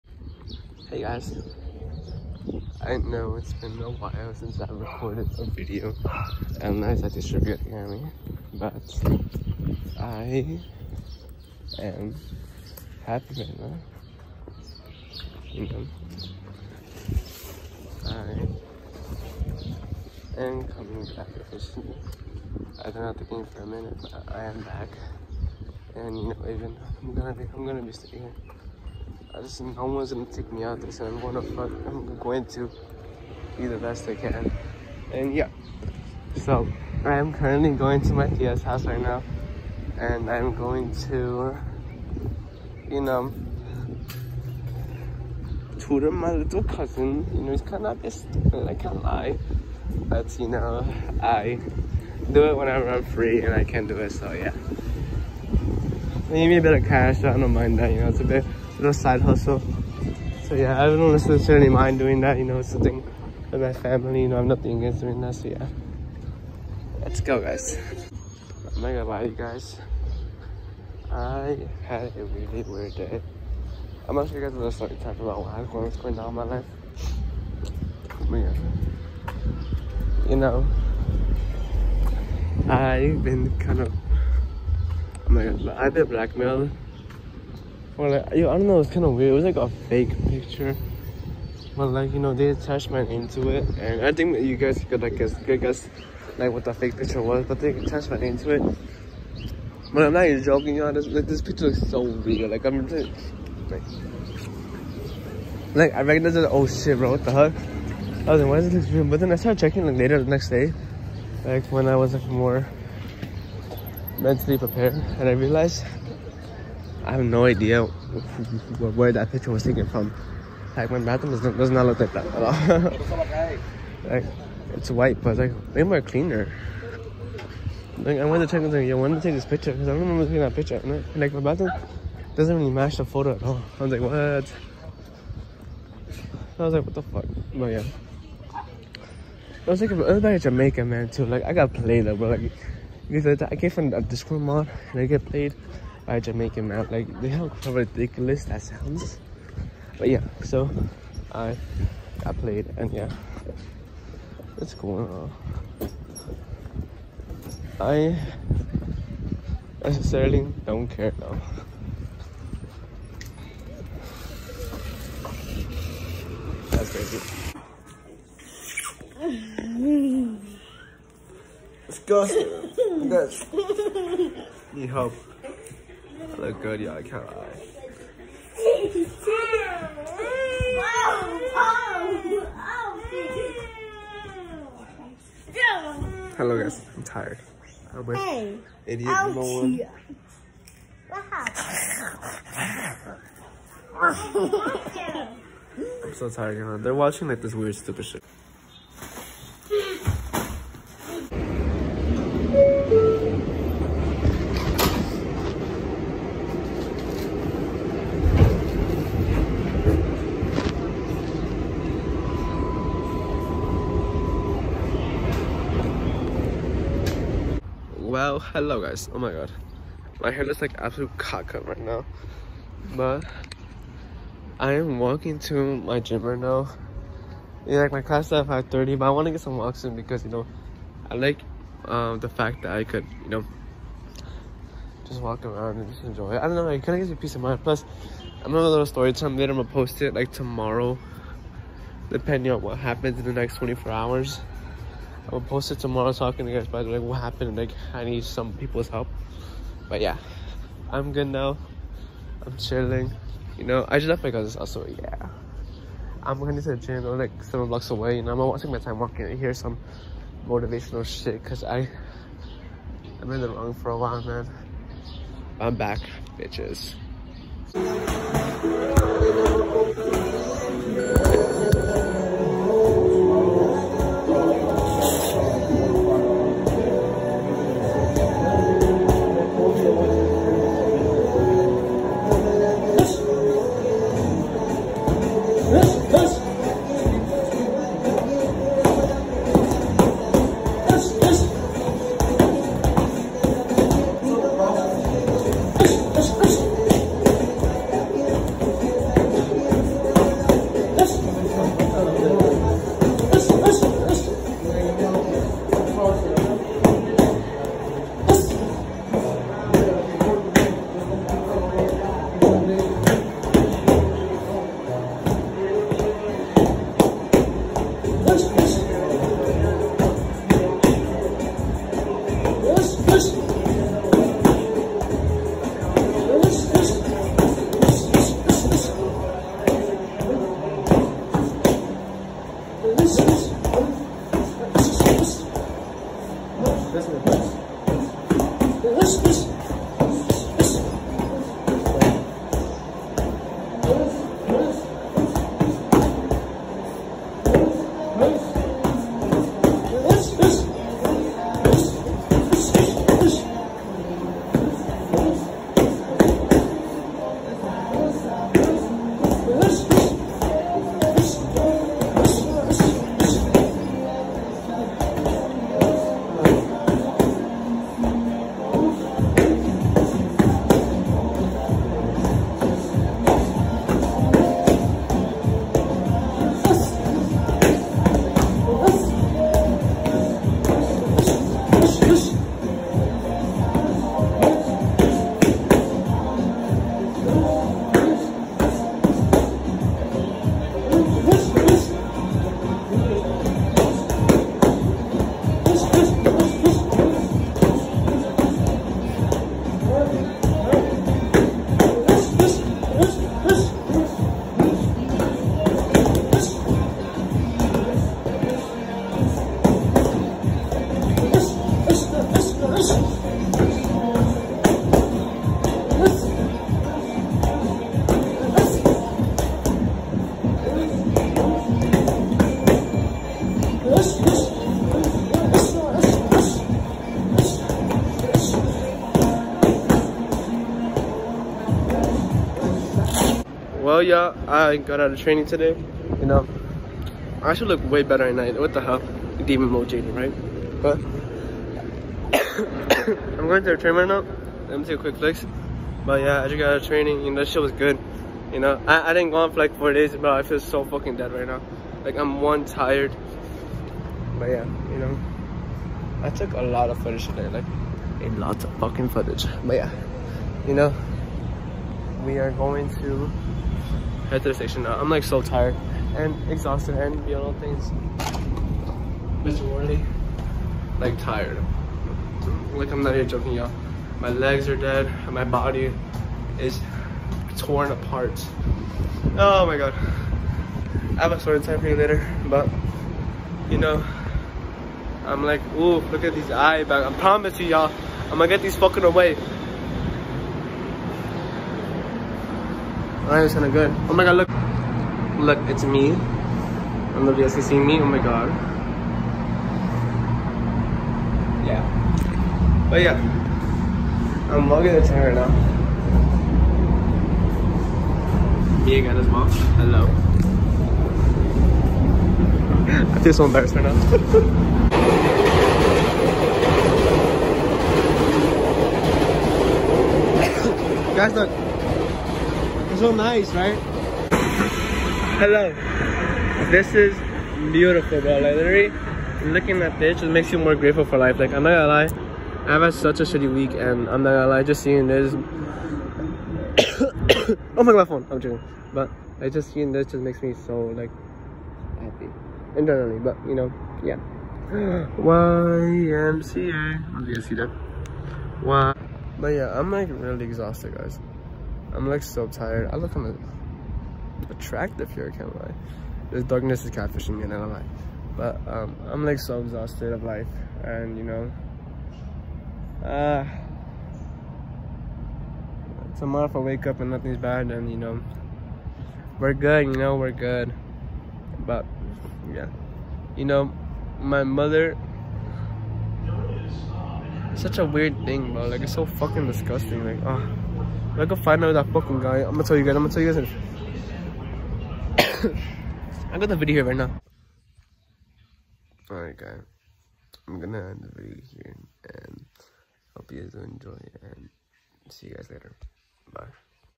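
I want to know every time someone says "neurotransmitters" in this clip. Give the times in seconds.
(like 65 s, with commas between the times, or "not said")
not said.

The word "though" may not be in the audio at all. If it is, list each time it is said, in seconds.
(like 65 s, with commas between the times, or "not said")
142 s, 161 s.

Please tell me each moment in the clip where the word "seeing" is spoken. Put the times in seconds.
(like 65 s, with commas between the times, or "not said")
534 s, 539 s.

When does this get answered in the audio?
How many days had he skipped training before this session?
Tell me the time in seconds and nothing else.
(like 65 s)
449 s.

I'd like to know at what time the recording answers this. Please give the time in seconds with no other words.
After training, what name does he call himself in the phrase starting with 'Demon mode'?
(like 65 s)
439 s.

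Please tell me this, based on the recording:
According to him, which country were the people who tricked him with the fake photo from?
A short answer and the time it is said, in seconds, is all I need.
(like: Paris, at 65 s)
Jamaica, at 140 s.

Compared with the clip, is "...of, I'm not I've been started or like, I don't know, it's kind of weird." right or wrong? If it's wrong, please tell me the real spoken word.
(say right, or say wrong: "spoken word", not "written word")
wrong: "blackmailed", not "started".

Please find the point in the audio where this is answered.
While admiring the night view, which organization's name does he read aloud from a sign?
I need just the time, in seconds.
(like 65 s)
544 s.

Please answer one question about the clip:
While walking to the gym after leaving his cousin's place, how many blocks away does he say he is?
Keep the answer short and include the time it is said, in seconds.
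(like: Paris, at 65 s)
7, at 257 s.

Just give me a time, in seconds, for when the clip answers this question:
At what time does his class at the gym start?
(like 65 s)
228 s.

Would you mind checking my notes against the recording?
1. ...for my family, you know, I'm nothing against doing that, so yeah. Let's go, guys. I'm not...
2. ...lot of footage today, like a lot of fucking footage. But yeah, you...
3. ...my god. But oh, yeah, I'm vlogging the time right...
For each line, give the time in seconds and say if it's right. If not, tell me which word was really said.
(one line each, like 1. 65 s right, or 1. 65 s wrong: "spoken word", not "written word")
1. 63 s right
2. 456 s right
3. 498 s right.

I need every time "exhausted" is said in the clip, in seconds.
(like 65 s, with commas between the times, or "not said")
466 s, 550 s, 559 s.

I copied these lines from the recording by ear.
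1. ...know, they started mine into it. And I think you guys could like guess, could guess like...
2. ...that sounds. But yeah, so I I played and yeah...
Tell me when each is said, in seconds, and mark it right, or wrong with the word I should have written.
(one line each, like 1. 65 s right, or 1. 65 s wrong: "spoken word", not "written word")
1. 92 s wrong: "attached", not "started"
2. 148 s right.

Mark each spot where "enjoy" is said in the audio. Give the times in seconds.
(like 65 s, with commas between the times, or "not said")
236 s, 593 s.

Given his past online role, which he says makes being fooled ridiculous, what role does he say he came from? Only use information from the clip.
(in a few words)
Discord mod.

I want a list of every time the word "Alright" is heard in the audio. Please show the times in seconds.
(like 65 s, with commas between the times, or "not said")
493 s, 589 s.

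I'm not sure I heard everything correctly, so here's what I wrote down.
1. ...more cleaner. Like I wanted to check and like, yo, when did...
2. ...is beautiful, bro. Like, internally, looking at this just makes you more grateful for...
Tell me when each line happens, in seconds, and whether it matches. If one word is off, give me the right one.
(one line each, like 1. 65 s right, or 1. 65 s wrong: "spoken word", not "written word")
1. 125 s right
2. 526 s wrong: "literally", not "internally".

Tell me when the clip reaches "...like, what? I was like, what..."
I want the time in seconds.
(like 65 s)
133 s.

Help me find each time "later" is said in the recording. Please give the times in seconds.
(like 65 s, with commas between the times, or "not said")
109 s, 239 s, 481 s, 595 s.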